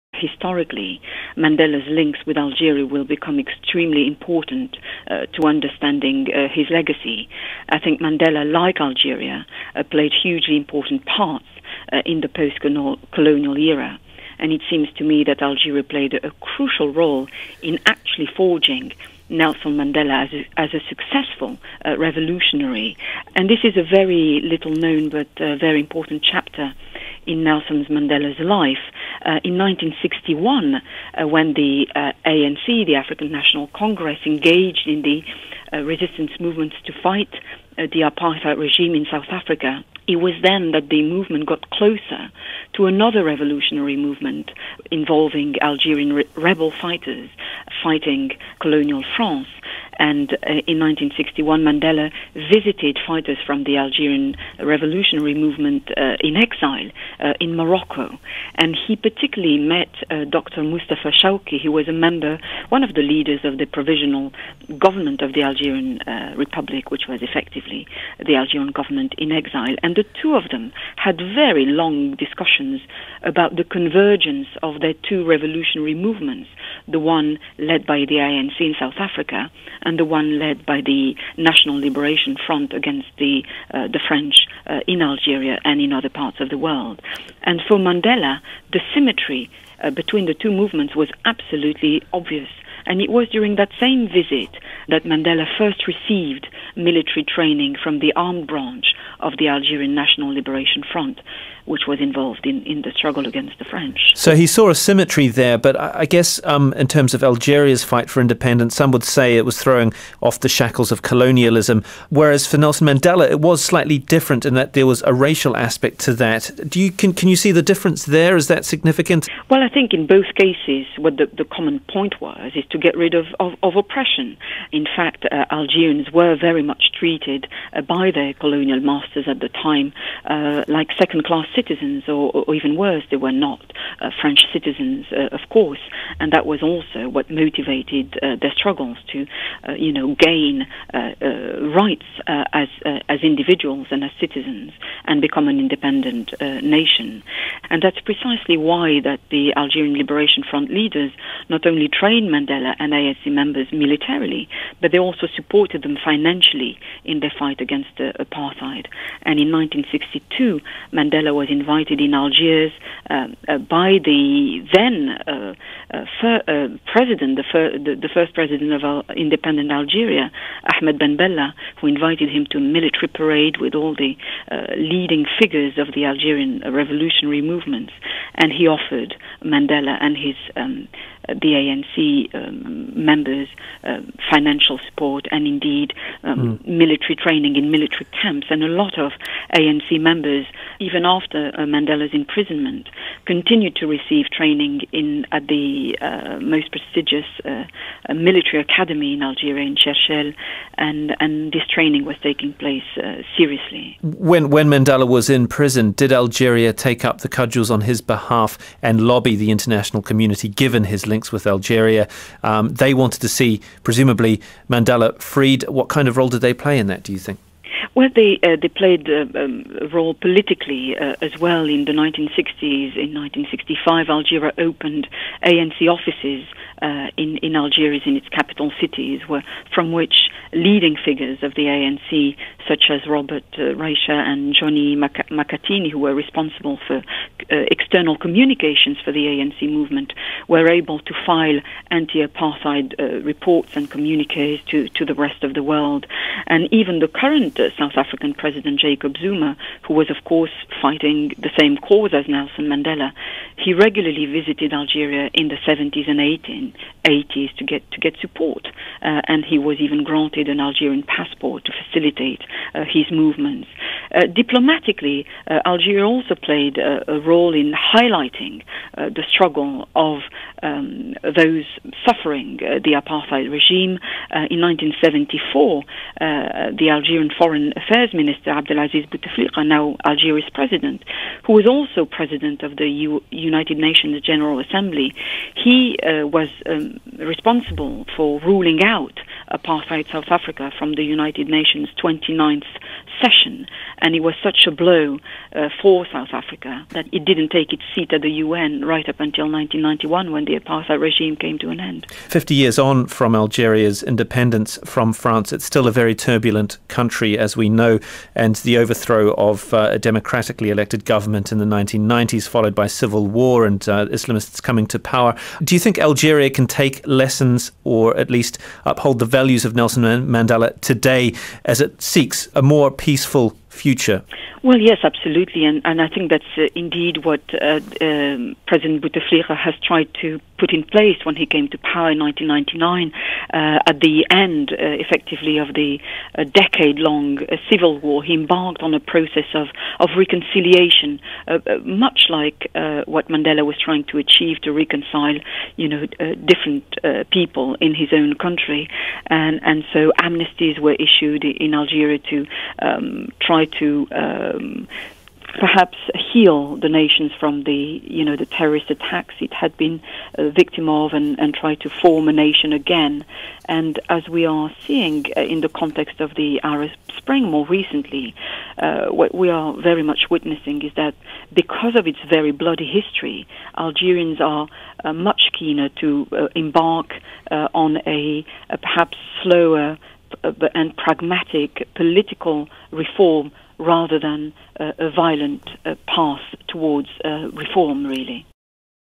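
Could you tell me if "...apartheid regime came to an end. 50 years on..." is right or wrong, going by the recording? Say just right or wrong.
right.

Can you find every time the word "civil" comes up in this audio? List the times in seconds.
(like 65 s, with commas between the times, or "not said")
312 s, 337 s.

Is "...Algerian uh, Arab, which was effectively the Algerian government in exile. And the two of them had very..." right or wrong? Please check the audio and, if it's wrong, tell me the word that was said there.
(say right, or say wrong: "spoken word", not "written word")
wrong: "Republic", not "Arab".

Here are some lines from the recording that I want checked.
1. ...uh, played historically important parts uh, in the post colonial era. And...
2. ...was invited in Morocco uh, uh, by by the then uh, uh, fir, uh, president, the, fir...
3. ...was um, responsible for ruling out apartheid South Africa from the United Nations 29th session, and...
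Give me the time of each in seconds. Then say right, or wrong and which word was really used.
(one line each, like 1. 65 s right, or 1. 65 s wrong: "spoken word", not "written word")
1. 9 s wrong: "hugely", not "historically"
2. 161 s wrong: "Algiers", not "Morocco"
3. 286 s right.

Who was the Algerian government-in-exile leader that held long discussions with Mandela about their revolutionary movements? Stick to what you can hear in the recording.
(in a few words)
Dr. Mustafa Shawki.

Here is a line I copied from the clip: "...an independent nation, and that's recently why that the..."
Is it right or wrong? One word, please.
wrong.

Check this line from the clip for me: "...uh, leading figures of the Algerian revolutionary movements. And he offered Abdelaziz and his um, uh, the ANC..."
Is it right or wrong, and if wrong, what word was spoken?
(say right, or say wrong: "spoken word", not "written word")
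wrong: "Mandela", not "Abdelaziz".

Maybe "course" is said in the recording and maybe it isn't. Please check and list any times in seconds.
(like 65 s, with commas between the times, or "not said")
135 s, 250 s.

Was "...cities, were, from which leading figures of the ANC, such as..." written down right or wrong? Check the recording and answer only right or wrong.
right.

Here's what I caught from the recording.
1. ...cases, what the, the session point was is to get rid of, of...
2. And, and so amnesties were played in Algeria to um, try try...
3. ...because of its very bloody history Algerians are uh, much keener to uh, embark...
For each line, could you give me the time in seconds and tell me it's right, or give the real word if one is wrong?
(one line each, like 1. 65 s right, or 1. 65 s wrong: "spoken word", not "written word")
1. 120 s wrong: "common", not "session"
2. 349 s wrong: "issued", not "played"
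3. 371 s right.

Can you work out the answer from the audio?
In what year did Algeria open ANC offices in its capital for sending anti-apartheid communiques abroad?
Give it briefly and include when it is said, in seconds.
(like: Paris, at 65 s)
1965, at 223 s.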